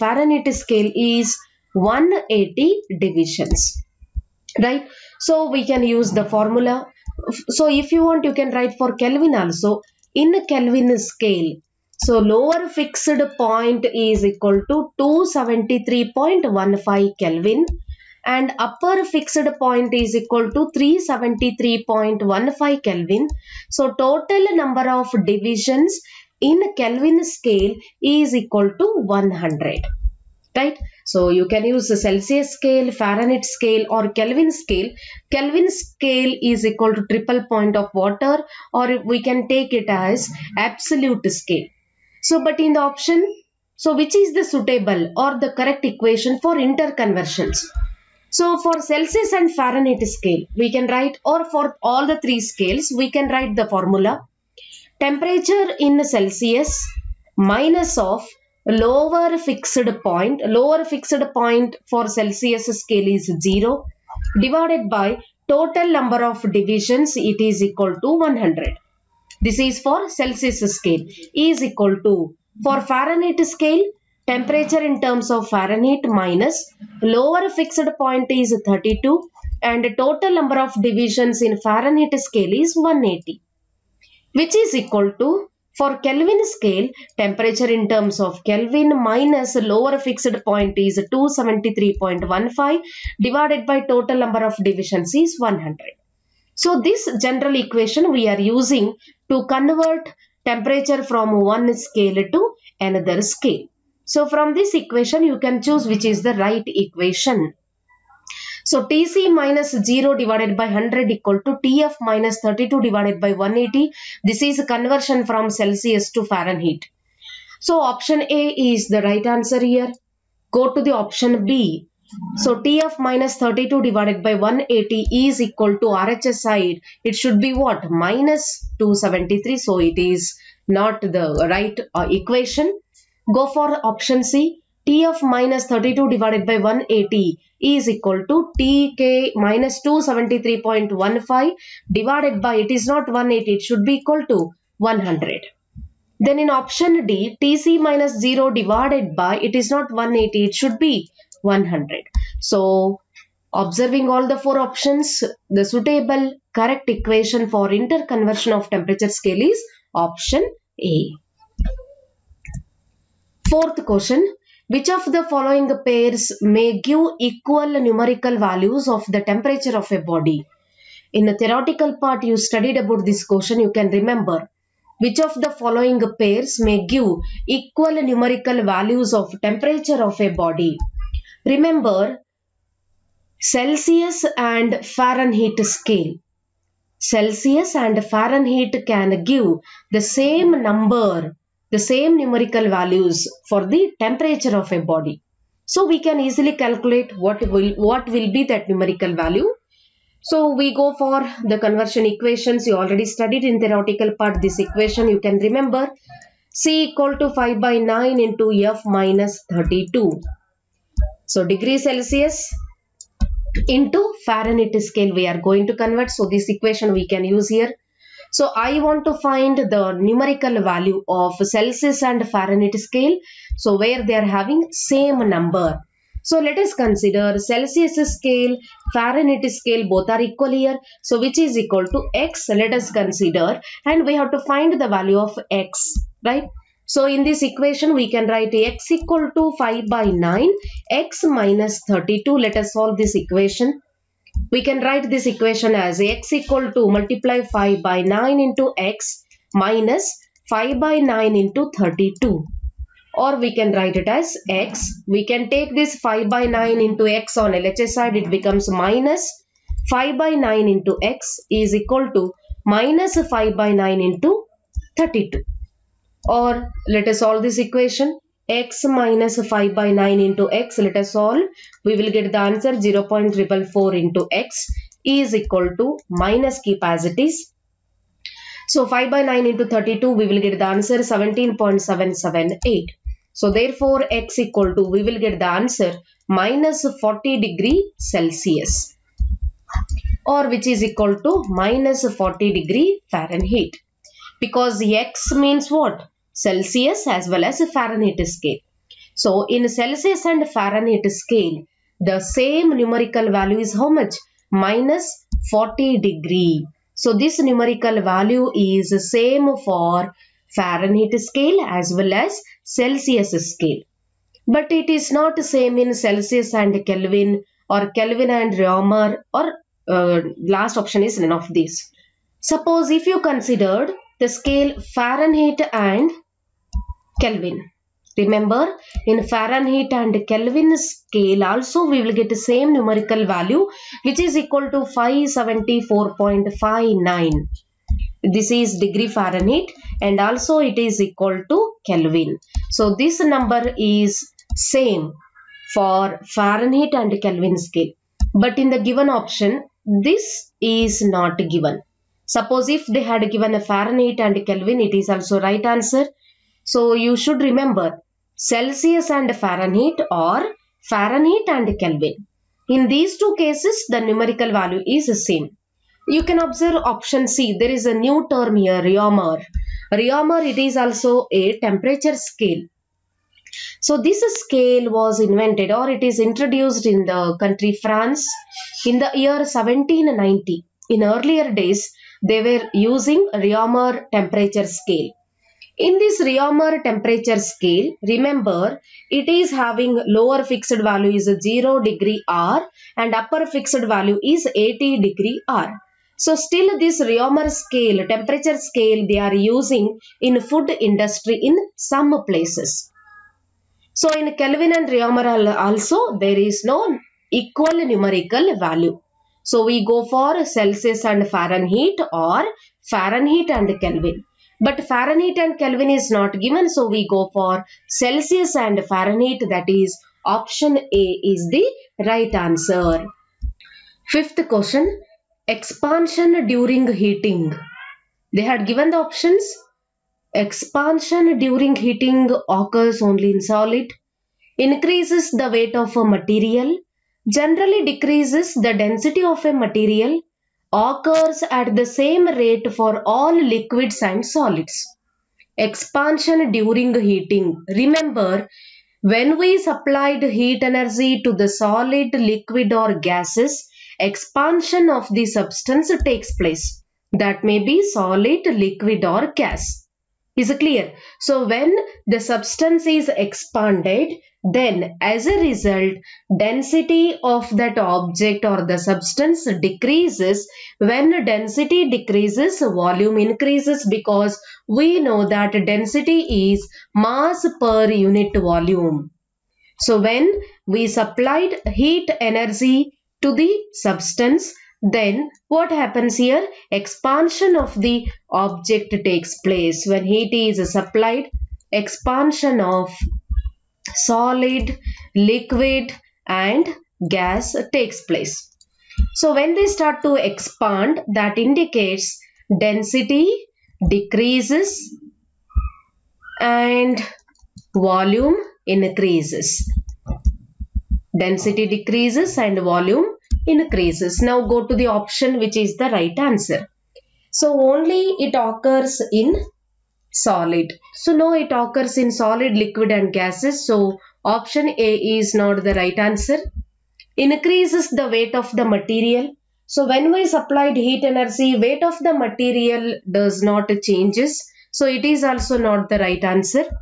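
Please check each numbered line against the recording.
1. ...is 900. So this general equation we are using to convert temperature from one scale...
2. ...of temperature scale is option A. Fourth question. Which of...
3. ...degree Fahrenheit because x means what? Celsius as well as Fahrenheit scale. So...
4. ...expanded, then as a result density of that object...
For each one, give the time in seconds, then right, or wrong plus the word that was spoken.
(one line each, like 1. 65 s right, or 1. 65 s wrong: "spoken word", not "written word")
1. 95 s wrong: "100", not "900"
2. 158 s right
3. 292 s right
4. 463 s right.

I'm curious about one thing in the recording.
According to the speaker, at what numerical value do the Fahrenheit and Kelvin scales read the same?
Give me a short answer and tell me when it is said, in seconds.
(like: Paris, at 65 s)
574.59, at 334 s.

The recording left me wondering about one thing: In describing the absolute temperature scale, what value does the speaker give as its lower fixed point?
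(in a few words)
273.15 K.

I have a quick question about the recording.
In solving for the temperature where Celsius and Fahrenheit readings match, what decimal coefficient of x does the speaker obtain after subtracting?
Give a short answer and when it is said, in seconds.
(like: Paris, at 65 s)
0.444, at 272 s.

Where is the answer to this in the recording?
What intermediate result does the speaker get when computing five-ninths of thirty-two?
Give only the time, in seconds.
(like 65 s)
280 s.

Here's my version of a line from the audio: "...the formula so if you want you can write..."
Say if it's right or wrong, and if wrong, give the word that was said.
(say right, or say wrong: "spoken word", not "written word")
right.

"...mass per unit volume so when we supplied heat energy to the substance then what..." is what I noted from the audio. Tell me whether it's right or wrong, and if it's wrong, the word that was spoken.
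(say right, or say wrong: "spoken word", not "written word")
right.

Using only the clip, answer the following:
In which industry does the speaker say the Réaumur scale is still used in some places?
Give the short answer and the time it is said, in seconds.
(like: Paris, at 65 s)
food industry, at 400 s.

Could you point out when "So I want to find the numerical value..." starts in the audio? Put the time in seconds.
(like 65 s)
218 s.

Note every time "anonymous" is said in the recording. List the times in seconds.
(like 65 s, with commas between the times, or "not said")
not said.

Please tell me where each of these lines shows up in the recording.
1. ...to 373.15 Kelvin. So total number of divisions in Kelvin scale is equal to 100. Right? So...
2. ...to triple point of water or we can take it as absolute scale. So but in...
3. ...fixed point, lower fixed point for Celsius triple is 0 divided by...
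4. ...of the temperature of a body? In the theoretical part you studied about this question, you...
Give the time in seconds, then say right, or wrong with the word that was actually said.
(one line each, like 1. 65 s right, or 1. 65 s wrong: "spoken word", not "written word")
1. 20 s right
2. 36 s right
3. 59 s wrong: "scale", not "triple"
4. 168 s right.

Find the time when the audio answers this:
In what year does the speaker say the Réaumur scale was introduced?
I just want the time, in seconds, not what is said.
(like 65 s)
379 s.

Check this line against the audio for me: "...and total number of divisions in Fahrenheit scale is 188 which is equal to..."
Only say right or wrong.
wrong.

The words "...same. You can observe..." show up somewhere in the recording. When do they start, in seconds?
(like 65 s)
365 s.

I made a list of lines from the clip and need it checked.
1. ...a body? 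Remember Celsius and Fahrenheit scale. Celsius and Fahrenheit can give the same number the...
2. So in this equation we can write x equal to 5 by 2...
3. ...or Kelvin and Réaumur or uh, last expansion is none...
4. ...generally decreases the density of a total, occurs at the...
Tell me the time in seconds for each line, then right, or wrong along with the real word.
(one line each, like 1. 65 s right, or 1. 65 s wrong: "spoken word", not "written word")
1. 180 s right
2. 236 s wrong: "9", not "2"
3. 317 s wrong: "option", not "expansion"
4. 437 s wrong: "material", not "total".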